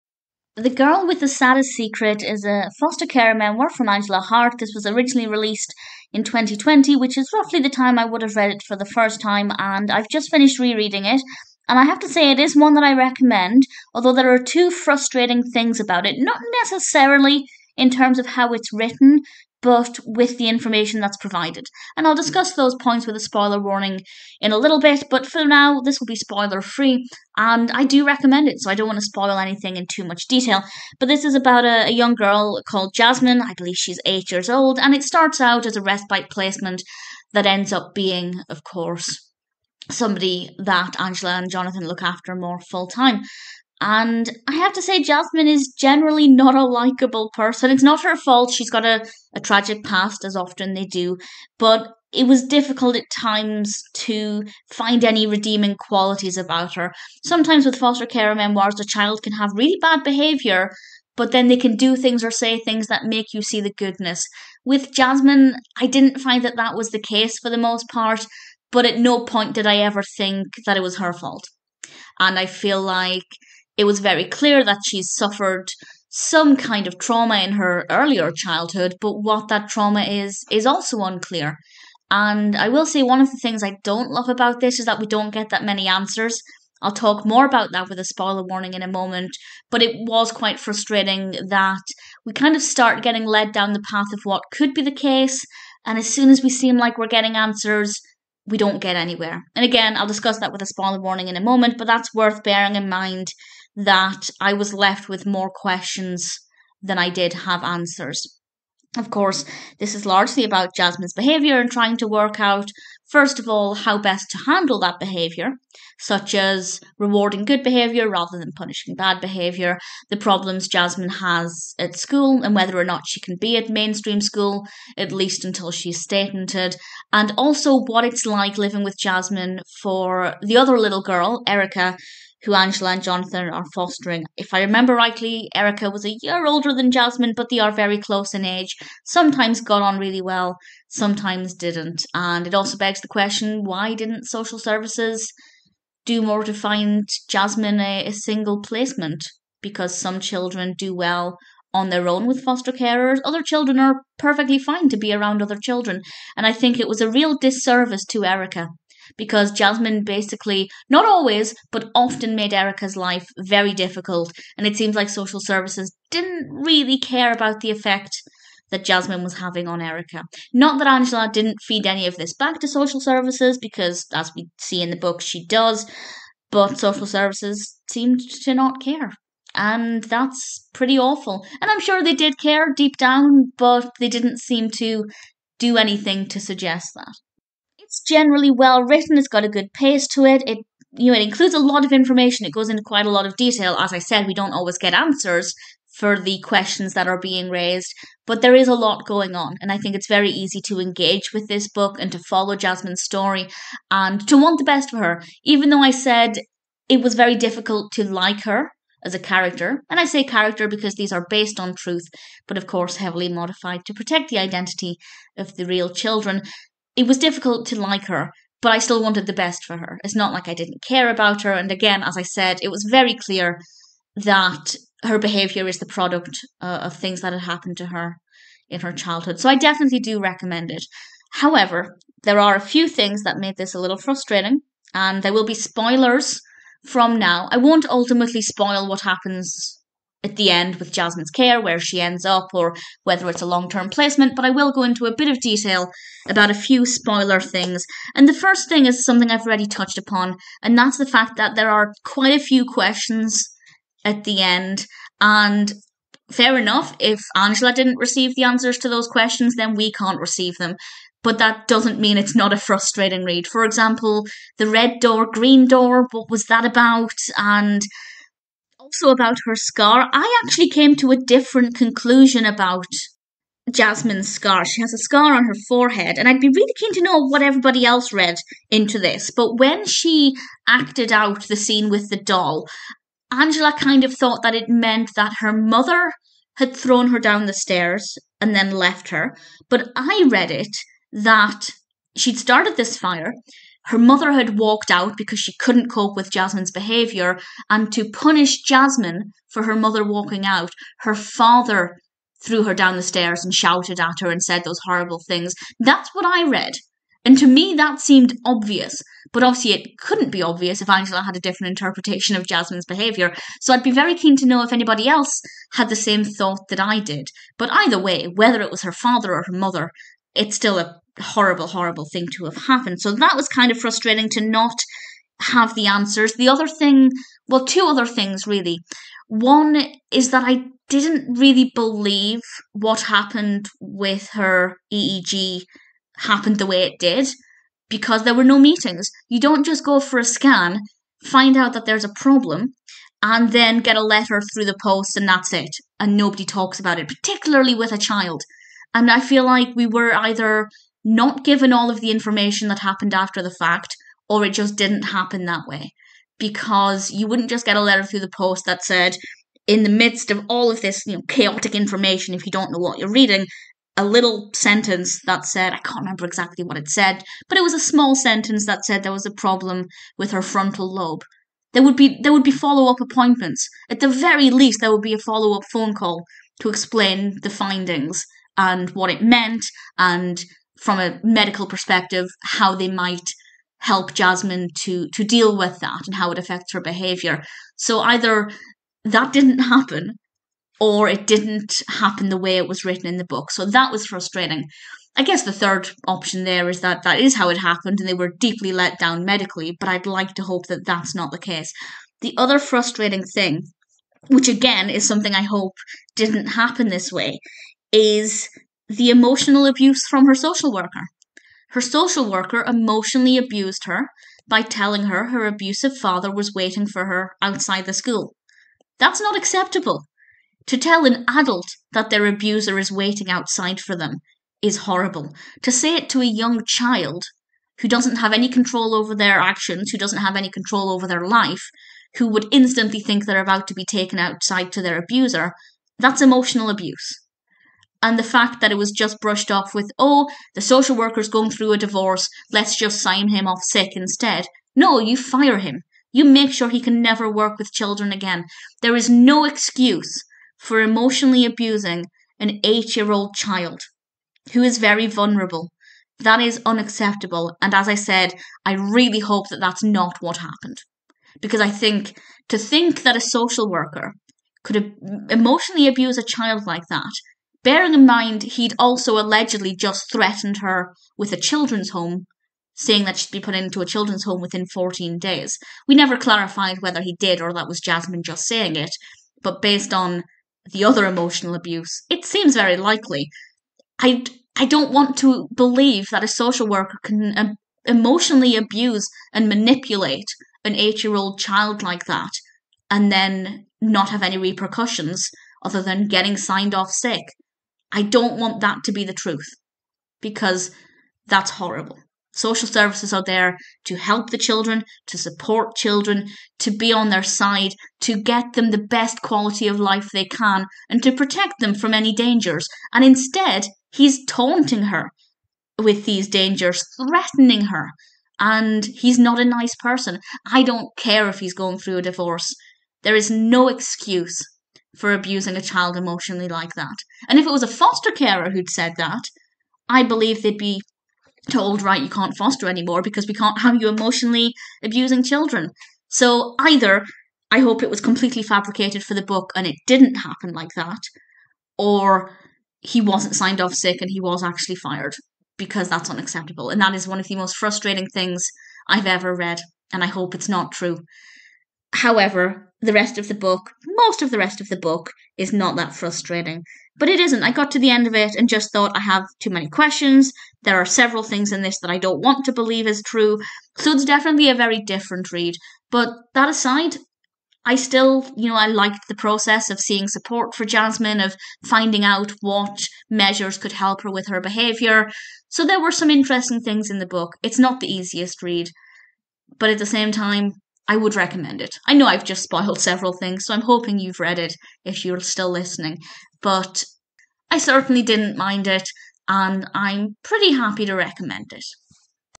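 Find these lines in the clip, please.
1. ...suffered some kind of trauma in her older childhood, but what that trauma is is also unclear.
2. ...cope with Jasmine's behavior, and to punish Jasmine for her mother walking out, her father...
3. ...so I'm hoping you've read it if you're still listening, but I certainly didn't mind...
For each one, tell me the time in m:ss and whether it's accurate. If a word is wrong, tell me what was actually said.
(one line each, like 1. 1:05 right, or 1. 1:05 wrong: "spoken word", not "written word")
1. 1:15 wrong: "earlier", not "older"
2. 4:55 right
3. 9:43 right.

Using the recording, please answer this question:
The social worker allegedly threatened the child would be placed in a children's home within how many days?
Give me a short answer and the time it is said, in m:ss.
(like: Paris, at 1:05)
14, at 7:54.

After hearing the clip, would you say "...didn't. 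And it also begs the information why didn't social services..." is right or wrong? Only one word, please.
wrong.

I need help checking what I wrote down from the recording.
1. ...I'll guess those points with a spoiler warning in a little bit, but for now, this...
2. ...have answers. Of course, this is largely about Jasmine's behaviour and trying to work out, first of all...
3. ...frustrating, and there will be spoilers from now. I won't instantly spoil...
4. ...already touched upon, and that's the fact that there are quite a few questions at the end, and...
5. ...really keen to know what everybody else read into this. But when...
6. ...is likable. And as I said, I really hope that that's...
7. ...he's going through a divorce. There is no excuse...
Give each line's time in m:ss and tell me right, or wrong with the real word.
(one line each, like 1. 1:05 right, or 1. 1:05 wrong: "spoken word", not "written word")
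1. 0:22 wrong: "discuss", not "guess"
2. 1:47 right
3. 3:53 wrong: "ultimately", not "instantly"
4. 4:09 right
5. 4:36 right
6. 7:36 wrong: "unacceptable", not "likable"
7. 8:41 right.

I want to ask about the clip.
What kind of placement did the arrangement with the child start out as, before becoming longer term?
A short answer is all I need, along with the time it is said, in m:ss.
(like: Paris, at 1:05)
Respite placement, at 0:35.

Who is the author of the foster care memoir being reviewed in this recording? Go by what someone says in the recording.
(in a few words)
Angela Hart.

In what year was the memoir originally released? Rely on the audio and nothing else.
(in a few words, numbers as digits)
2020.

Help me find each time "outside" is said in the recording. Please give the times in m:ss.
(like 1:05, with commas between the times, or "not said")
6:57, 7:03, 7:14.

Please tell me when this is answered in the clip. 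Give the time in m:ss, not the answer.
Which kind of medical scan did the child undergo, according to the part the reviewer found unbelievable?
5:34.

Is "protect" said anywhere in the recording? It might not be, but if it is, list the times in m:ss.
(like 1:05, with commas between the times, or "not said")
3:33, 8:31.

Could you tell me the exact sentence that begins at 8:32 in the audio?
And instead, he's taunting her with these dangers, threatening her.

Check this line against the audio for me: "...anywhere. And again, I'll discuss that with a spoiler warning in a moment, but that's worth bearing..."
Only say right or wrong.
right.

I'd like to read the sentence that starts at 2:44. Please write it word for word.
And it seems like social services didn't really care about the effect that Jasmine was having on Erica.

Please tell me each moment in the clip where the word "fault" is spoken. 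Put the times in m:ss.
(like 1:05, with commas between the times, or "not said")
0:48, 1:11.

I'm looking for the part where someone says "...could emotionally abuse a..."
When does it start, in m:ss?
7:44.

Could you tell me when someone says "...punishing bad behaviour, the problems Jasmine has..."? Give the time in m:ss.
1:58.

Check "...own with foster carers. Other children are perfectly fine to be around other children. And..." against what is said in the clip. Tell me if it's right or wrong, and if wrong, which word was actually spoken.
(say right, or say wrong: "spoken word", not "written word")
right.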